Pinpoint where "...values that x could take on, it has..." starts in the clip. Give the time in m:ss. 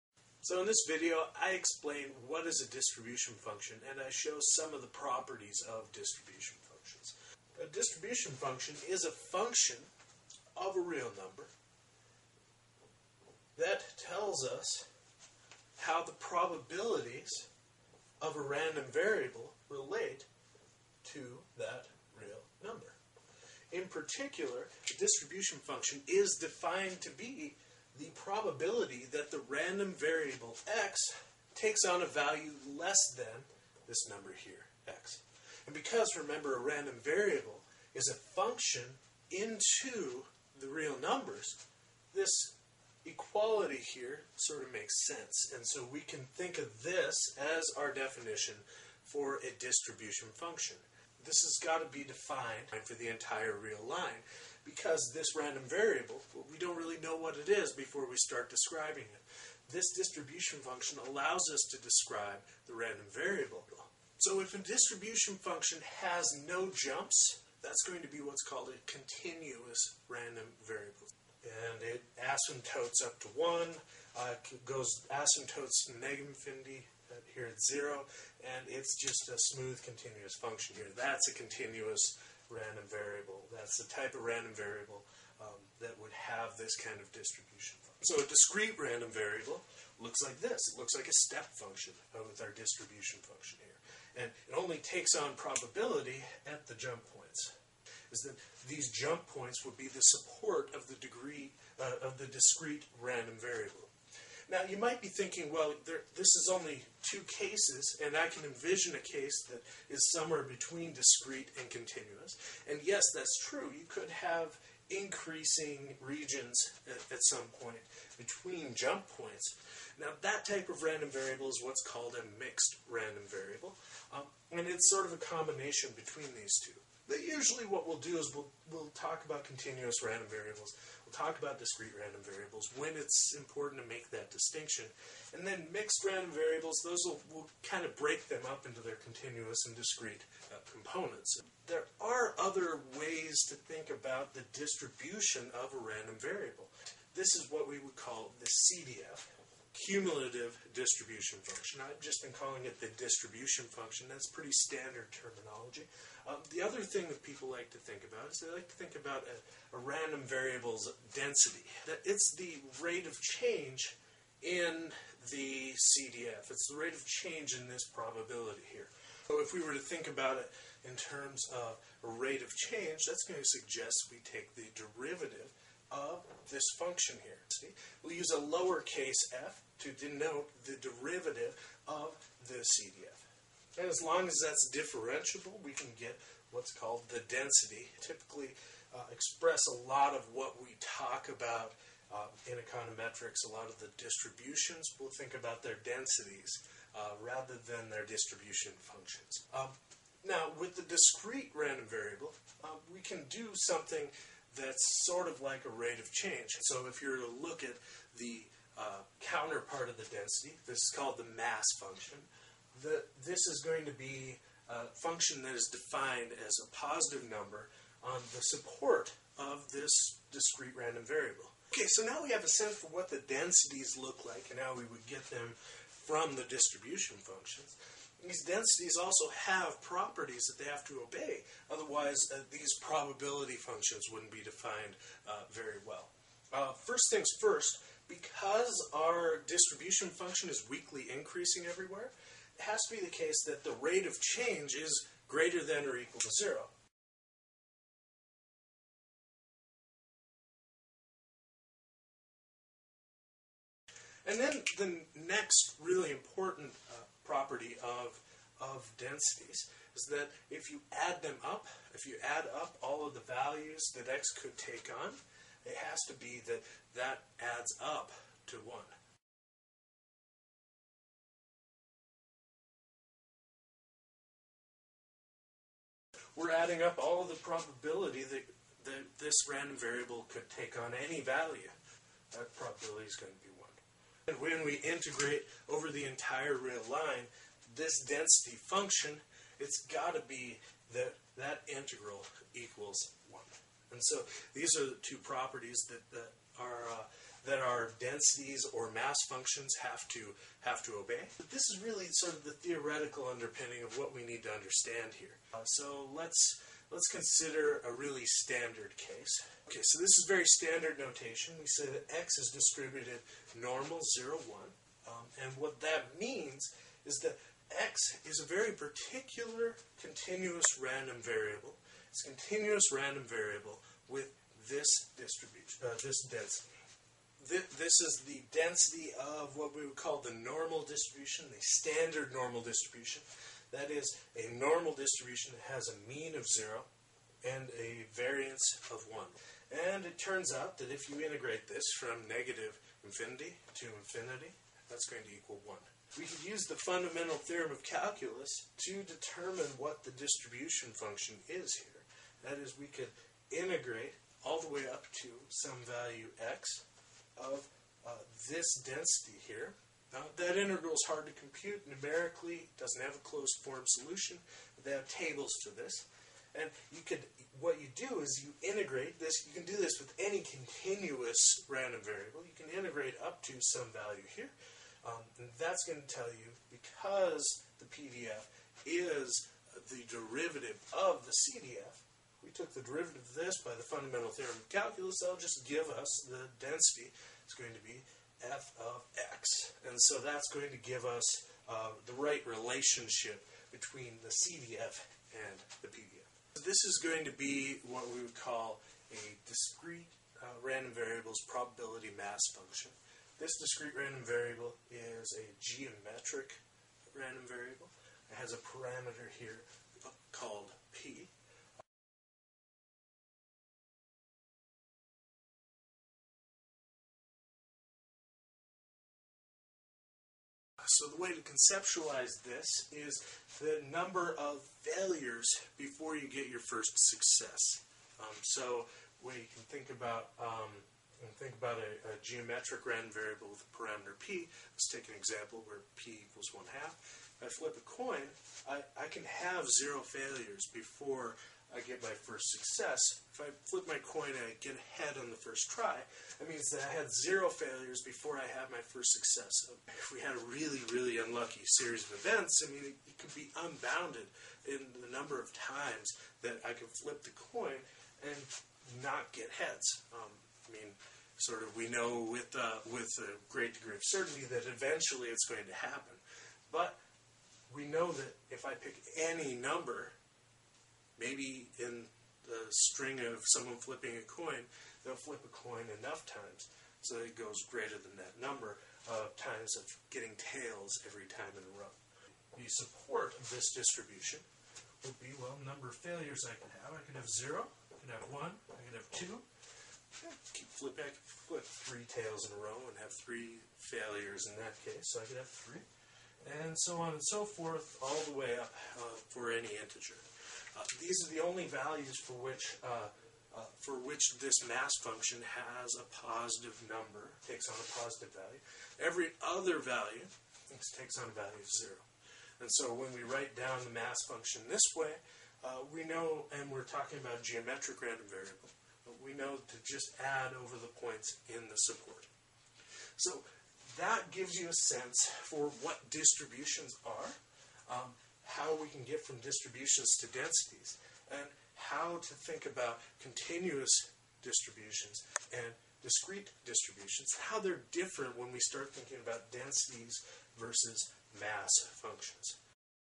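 4:23.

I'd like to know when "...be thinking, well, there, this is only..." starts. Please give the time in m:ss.
1:45.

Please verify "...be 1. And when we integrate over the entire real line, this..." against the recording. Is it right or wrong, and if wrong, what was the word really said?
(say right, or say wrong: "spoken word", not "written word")
right.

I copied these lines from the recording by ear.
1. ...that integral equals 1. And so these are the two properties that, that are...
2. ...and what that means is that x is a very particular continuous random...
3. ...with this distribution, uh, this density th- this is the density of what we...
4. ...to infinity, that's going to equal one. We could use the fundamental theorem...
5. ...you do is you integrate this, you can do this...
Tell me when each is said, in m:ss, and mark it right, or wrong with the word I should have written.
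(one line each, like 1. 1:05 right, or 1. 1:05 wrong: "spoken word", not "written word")
1. 4:51 right
2. 5:15 right
3. 5:24 right
4. 5:43 right
5. 6:07 right.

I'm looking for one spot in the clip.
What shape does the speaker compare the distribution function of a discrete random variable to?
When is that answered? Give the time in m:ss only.
1:31.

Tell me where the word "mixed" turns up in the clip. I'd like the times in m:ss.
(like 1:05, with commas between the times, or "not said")
2:02, 2:15.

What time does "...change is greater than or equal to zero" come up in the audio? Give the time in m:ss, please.
4:04.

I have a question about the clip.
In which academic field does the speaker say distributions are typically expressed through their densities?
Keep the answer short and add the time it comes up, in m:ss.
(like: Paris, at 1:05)
Econometrics, at 3:12.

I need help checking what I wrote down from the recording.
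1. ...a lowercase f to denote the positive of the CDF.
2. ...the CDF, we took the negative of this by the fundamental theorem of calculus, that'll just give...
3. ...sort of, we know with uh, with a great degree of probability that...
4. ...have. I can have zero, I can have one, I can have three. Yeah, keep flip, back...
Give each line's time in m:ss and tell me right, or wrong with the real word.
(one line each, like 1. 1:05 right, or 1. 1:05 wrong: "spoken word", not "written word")
1. 2:58 wrong: "derivative", not "positive"
2. 6:21 wrong: "derivative", not "negative"
3. 7:41 wrong: "certainty", not "probability"
4. 8:06 wrong: "two", not "three".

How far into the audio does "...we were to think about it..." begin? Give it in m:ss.
2:49.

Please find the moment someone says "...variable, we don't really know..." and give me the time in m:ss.
0:55.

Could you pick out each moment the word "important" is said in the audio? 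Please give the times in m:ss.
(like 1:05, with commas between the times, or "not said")
2:13, 4:16.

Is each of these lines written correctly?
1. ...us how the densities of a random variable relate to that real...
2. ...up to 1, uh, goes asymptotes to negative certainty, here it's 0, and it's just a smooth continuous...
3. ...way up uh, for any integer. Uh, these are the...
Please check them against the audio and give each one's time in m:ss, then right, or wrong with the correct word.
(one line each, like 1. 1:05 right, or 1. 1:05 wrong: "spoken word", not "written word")
1. 0:14 wrong: "probabilities", not "densities"
2. 1:13 wrong: "infinity", not "certainty"
3. 8:18 right.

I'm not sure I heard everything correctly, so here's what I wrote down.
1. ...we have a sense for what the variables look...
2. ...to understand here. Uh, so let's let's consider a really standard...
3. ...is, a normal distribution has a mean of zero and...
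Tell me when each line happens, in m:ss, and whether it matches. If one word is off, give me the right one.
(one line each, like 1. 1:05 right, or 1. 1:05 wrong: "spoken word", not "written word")
1. 3:42 wrong: "densities", not "variables"
2. 5:04 right
3. 5:33 right.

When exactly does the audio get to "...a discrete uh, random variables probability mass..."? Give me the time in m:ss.
6:39.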